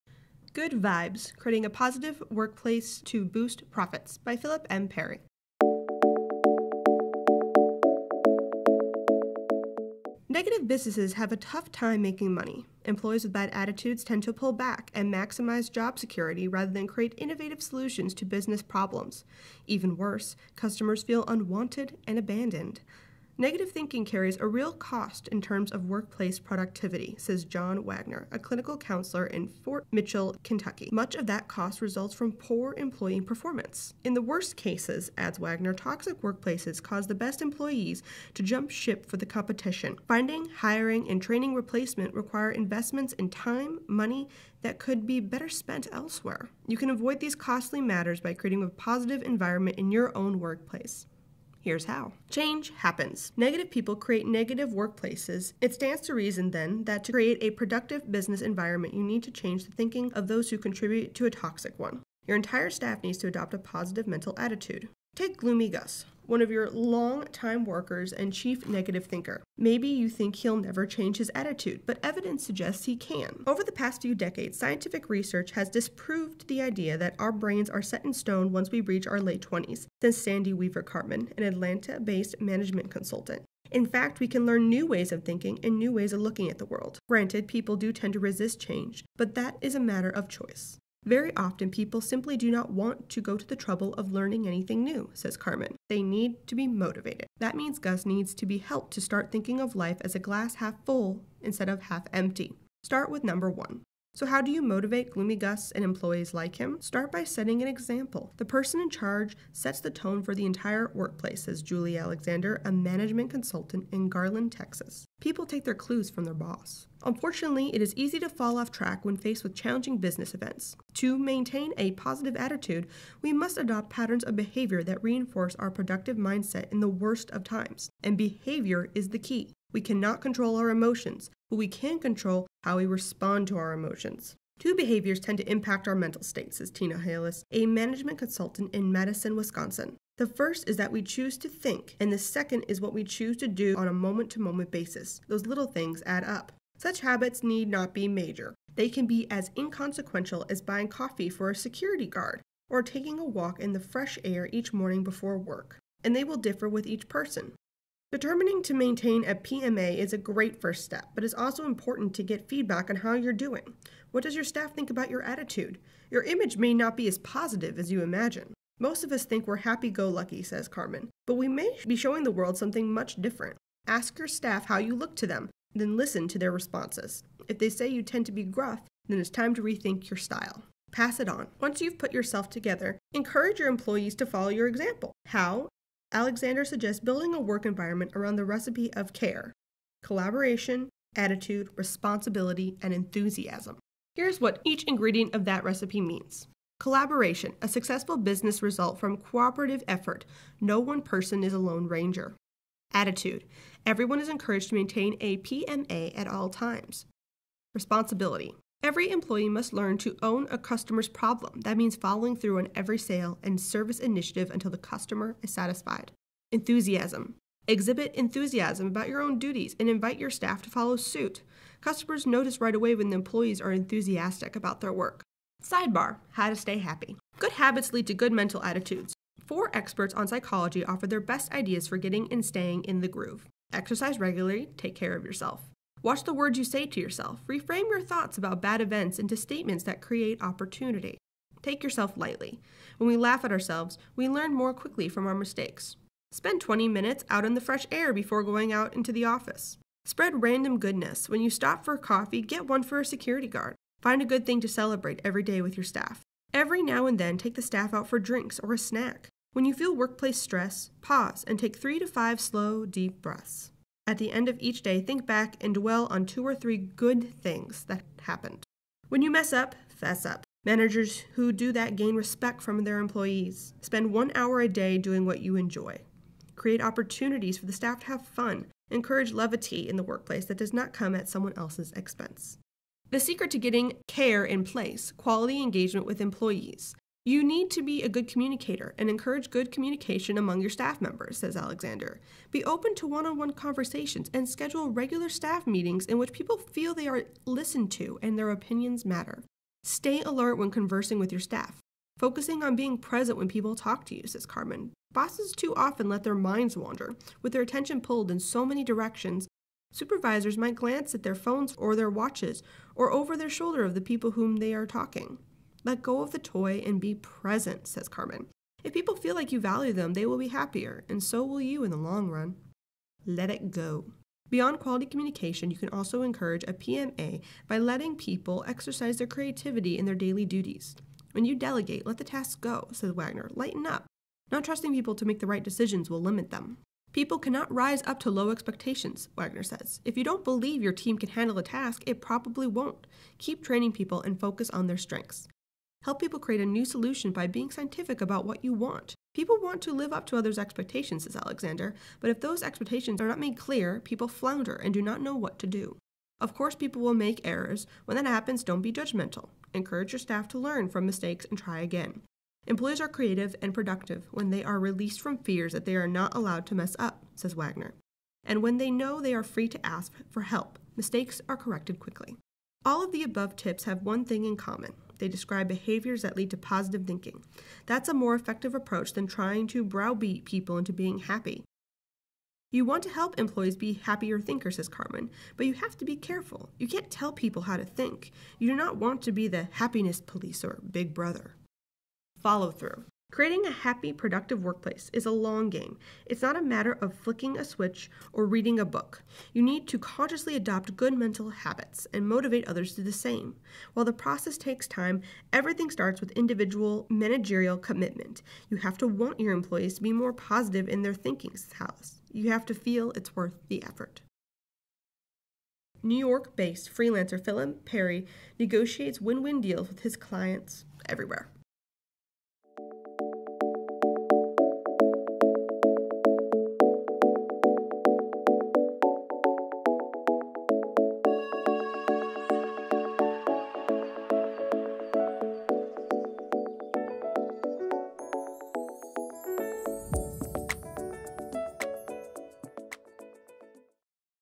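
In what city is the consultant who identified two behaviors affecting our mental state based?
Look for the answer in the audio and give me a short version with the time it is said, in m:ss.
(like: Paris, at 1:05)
Madison, Wisconsin, at 2:18.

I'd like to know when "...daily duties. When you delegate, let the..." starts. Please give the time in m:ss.
5:30.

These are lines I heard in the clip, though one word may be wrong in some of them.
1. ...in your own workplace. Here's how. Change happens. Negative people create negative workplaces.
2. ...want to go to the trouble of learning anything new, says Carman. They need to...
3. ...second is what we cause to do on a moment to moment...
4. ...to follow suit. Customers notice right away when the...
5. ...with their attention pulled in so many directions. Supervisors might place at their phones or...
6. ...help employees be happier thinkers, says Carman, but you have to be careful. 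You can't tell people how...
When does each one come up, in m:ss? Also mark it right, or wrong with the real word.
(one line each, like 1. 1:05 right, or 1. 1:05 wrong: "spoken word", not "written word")
1. 0:49 right
2. 1:32 right
3. 2:22 wrong: "choose", not "cause"
4. 3:40 right
5. 5:07 wrong: "glance", not "place"
6. 6:23 right.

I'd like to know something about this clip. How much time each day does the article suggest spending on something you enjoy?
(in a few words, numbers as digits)
one hour.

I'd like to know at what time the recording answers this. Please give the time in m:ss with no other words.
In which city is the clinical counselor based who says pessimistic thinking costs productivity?
0:29.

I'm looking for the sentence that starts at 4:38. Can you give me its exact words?
Encourage levity in the workplace that does not come at someone else's expense.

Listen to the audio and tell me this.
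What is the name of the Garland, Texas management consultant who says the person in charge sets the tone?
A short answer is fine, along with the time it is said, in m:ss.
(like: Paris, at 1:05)
Julie Alexander, at 1:51.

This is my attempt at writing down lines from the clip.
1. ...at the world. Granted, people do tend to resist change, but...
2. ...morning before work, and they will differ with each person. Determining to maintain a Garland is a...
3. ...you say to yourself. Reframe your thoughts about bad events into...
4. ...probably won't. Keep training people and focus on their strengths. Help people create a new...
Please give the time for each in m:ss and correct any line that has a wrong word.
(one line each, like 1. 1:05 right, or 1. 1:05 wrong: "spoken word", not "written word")
1. 1:26 right
2. 2:34 wrong: "PMA", not "Garland"
3. 3:56 right
4. 5:42 right.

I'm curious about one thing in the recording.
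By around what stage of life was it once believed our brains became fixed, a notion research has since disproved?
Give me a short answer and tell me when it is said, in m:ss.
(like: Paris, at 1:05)
late 20s, at 1:19.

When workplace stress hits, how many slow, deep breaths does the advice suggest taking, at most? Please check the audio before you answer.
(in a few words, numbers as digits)
5.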